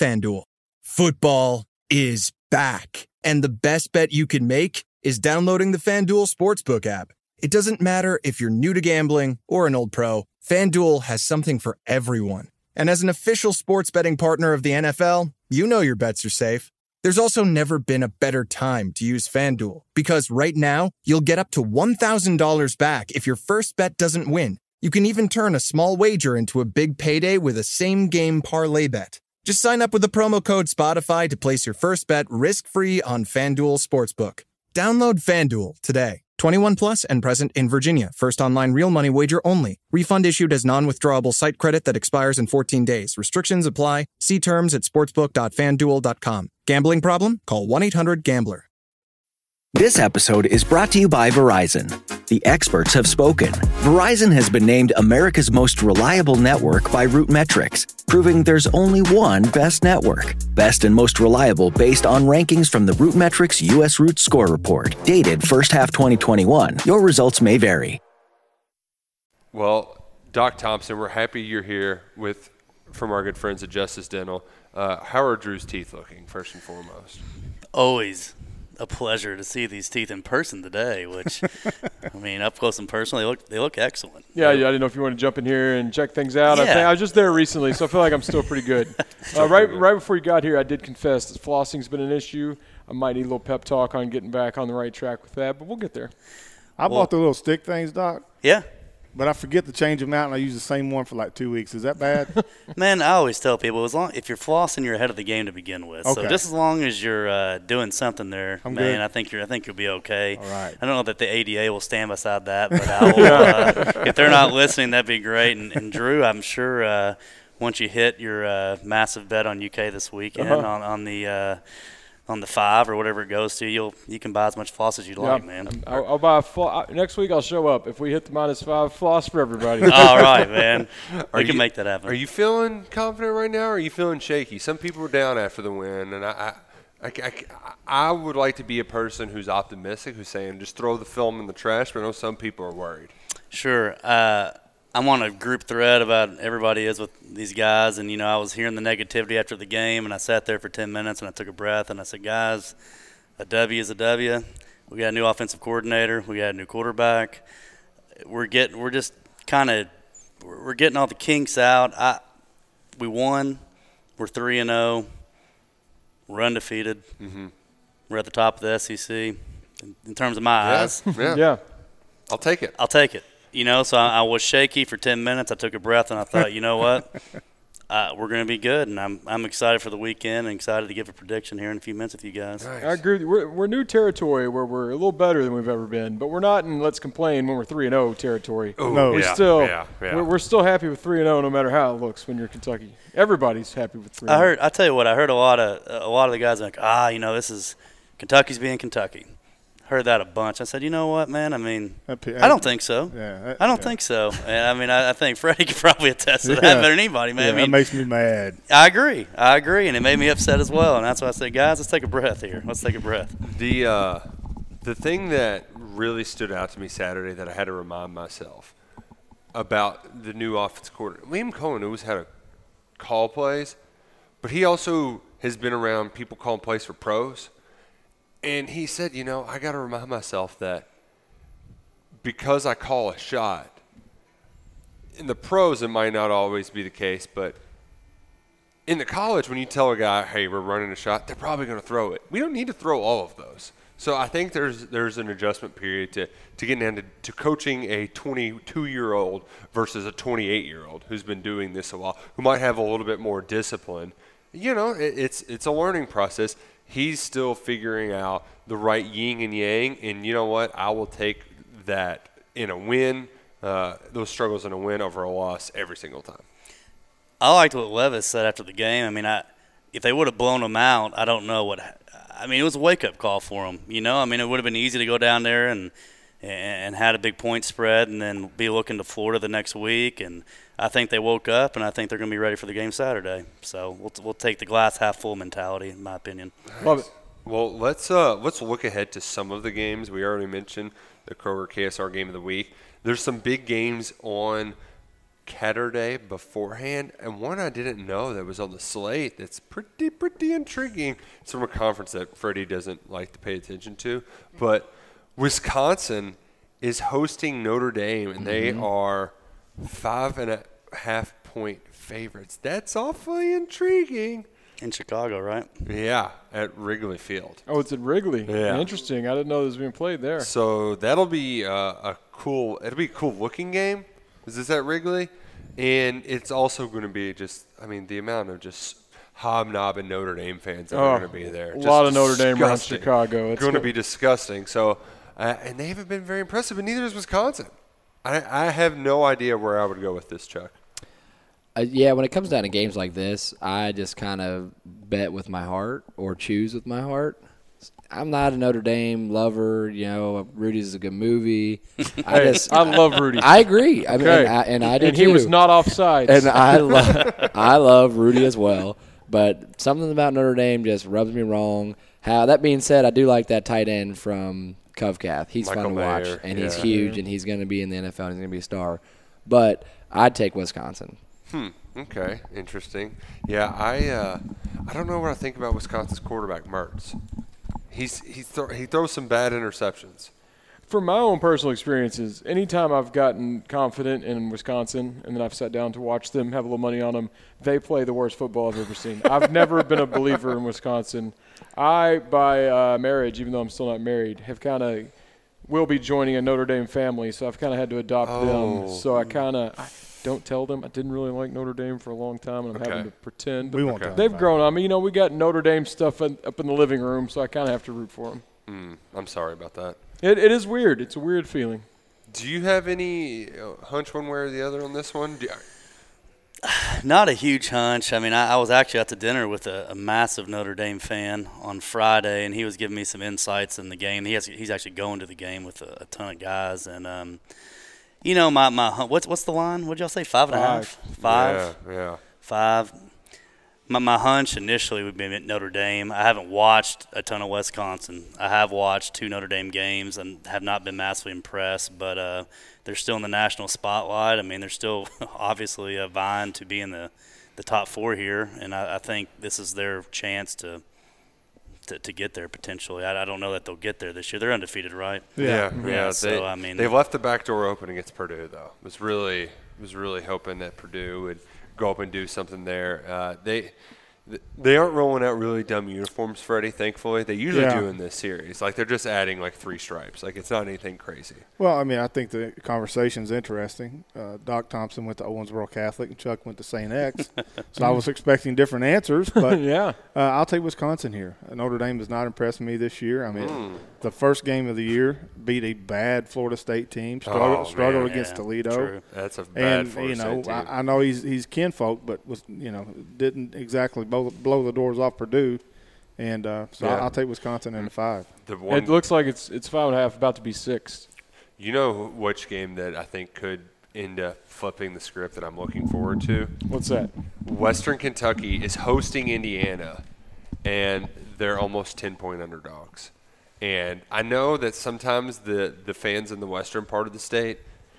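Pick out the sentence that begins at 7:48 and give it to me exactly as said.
Like they're just adding like three stripes.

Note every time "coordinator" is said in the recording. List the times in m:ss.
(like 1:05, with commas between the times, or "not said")
2:35, 3:40.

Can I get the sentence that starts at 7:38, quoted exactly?
Was really was really hoping that Purdue would go up and do something there.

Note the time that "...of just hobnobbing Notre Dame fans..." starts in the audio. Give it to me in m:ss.
5:28.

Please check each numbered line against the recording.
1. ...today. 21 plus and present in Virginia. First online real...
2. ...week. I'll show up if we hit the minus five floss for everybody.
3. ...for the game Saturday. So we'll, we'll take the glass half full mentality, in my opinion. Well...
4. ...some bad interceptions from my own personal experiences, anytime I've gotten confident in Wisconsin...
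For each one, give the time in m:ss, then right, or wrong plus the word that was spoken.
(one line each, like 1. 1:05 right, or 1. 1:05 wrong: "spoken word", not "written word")
1. 0:35 right
2. 2:07 right
3. 4:42 right
4. 6:19 right.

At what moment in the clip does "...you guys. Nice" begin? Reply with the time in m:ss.
3:02.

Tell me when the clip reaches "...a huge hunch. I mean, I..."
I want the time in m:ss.
6:57.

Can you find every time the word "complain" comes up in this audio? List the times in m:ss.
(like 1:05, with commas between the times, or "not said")
3:06.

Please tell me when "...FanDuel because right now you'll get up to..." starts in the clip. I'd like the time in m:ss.
0:19.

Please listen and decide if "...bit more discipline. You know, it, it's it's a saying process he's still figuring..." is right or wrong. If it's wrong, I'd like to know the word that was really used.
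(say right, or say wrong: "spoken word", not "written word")
wrong: "learning", not "saying".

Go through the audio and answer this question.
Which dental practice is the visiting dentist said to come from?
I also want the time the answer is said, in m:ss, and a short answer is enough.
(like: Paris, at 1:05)
Justice Dental, at 1:13.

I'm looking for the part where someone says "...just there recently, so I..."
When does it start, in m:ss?
1:26.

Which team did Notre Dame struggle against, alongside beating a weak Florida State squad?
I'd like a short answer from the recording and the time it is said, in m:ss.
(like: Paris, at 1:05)
Toledo, at 8:08.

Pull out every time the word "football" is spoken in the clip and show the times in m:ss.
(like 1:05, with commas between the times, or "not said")
0:00, 6:28.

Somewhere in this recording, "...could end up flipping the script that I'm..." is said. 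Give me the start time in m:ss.
8:23.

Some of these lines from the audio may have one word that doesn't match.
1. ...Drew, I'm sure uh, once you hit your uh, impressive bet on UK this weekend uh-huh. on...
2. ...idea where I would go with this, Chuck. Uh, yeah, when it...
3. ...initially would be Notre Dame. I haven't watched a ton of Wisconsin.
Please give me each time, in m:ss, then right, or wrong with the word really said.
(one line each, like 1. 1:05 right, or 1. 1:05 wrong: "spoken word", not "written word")
1. 1:55 wrong: "massive", not "impressive"
2. 5:39 right
3. 7:14 right.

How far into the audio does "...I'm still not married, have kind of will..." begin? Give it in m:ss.
6:33.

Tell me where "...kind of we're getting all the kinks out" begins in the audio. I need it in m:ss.
2:39.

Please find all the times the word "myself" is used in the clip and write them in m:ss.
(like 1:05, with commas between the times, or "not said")
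3:38, 3:50.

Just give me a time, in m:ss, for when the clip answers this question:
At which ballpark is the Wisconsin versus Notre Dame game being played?
5:16.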